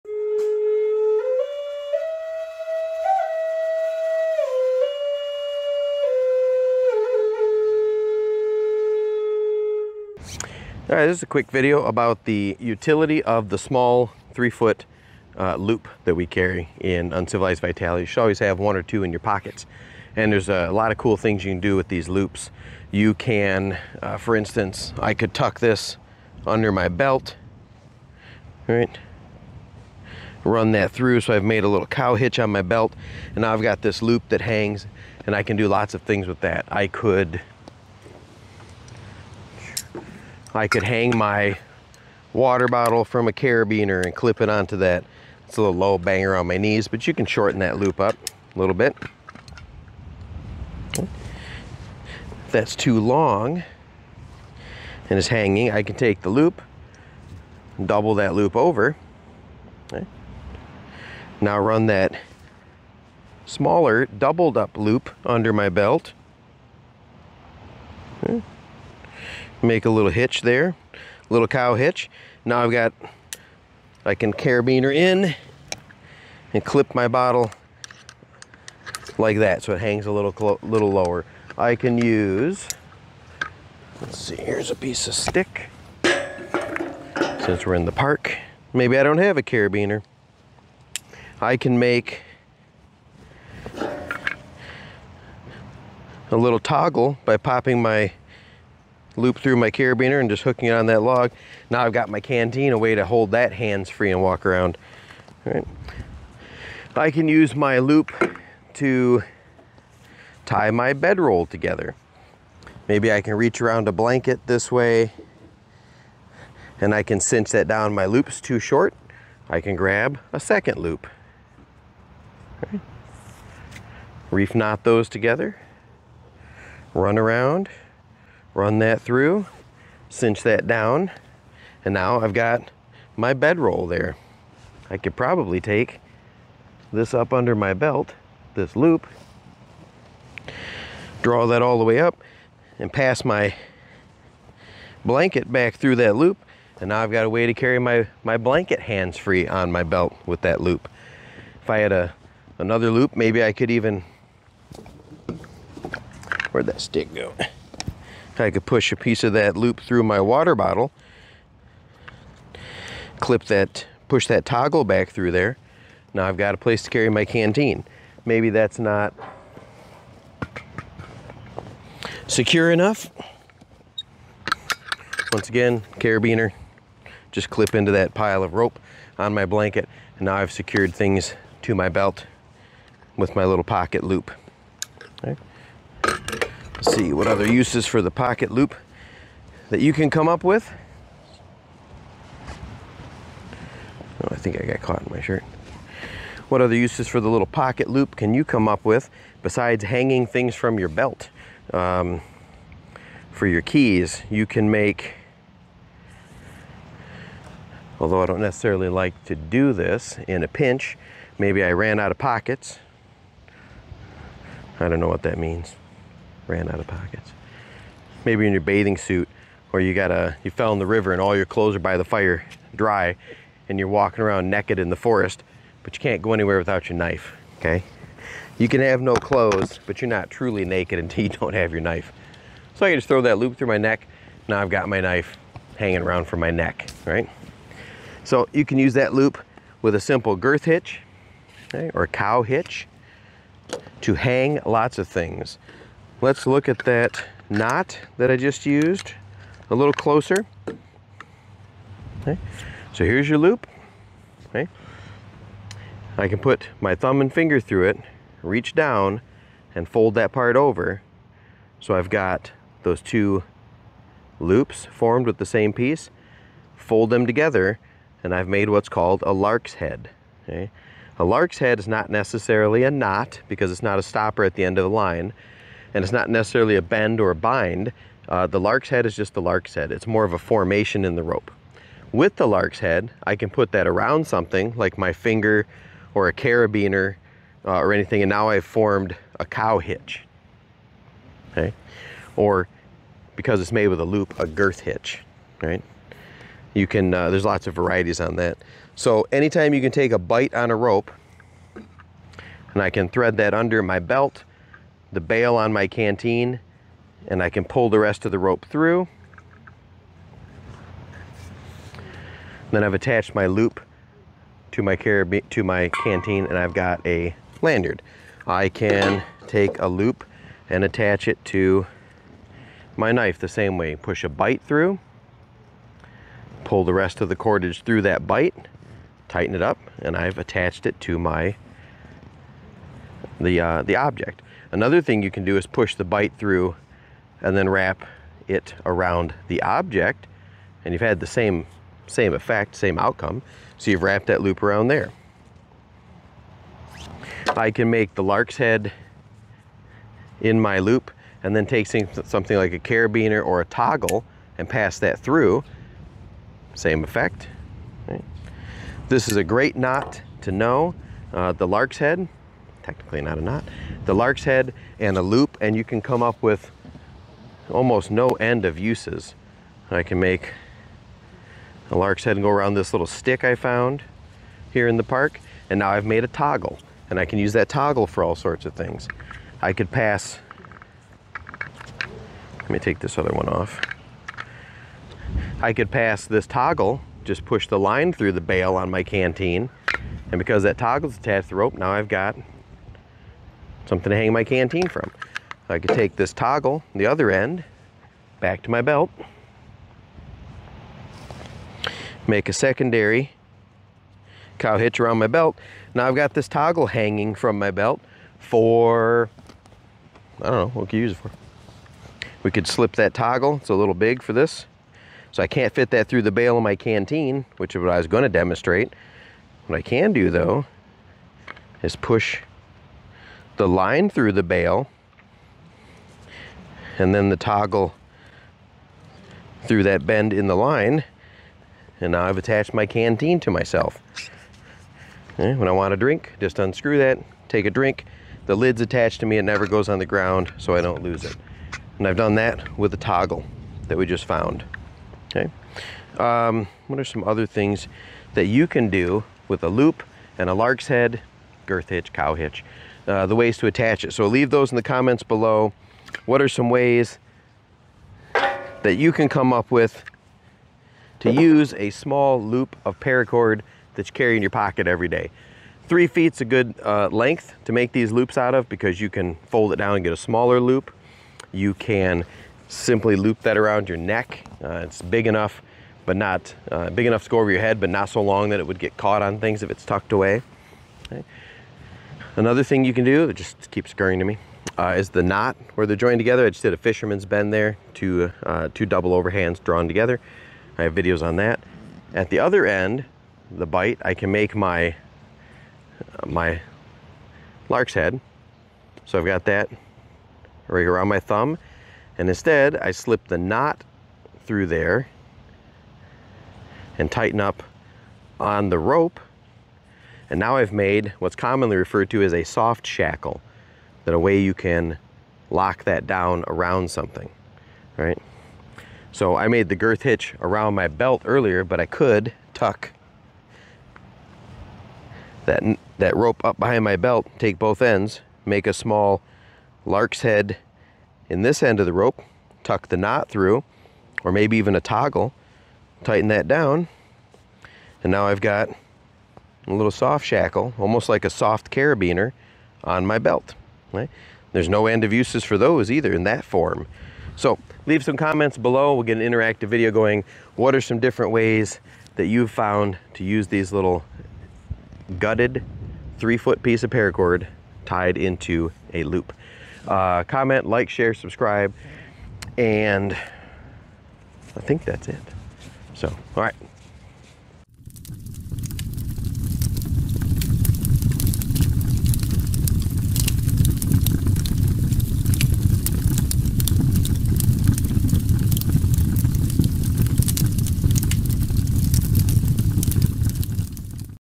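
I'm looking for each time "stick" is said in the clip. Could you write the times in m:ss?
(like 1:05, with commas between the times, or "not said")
1:25, 2:36, 6:13.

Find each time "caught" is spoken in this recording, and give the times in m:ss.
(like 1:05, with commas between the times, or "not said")
3:14, 7:58.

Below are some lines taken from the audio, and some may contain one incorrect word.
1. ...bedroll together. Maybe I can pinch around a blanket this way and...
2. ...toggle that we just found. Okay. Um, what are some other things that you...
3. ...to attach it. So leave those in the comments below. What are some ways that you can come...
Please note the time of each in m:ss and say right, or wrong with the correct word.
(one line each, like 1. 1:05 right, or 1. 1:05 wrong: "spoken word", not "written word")
1. 1:50 wrong: "reach", not "pinch"
2. 7:22 right
3. 7:33 right.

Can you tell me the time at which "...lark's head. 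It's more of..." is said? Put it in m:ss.
4:39.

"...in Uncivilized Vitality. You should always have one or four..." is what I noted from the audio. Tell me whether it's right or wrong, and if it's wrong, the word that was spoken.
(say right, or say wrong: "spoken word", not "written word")
wrong: "two", not "four".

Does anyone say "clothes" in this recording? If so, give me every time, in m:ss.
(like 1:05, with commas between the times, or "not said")
3:41, 3:49.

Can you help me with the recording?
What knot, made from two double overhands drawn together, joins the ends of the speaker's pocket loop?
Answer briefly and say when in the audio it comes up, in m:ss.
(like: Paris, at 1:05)
Fisherman's bend, at 8:06.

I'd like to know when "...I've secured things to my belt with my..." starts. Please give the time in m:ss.
3:00.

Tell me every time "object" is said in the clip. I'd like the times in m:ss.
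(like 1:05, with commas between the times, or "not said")
5:33, 5:39.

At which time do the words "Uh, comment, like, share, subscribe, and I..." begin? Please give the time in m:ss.
9:19.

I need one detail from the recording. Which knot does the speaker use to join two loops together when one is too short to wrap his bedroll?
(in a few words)
Reef knot.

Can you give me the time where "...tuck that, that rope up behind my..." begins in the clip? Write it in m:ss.
8:42.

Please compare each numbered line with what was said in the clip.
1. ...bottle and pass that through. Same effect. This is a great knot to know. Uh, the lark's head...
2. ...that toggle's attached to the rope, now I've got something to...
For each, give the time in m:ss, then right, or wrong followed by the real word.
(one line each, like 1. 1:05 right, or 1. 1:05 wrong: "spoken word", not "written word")
1. 5:53 wrong: "toggle", not "bottle"
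2. 6:30 right.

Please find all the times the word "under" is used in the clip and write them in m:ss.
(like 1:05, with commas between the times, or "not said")
0:26, 1:05, 2:17, 5:03.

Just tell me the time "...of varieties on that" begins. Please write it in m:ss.
4:57.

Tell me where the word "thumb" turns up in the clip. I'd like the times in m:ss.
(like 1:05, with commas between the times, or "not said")
4:16, 8:21.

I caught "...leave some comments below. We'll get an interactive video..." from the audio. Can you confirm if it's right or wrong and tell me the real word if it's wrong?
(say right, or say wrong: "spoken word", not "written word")
right.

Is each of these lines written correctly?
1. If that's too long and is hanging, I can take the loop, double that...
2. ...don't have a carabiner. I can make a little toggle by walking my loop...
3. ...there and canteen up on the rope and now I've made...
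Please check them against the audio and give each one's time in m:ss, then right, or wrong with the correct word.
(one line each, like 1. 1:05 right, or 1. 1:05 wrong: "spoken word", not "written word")
1. 0:50 right
2. 1:29 wrong: "popping", not "walking"
3. 8:24 wrong: "tighten", not "canteen".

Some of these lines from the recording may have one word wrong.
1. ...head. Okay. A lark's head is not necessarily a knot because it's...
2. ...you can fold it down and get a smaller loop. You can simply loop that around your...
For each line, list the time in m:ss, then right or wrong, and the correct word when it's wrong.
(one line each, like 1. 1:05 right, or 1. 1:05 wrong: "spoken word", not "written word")
1. 4:29 right
2. 7:48 right.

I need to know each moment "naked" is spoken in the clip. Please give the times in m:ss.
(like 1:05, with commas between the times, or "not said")
3:44, 3:50.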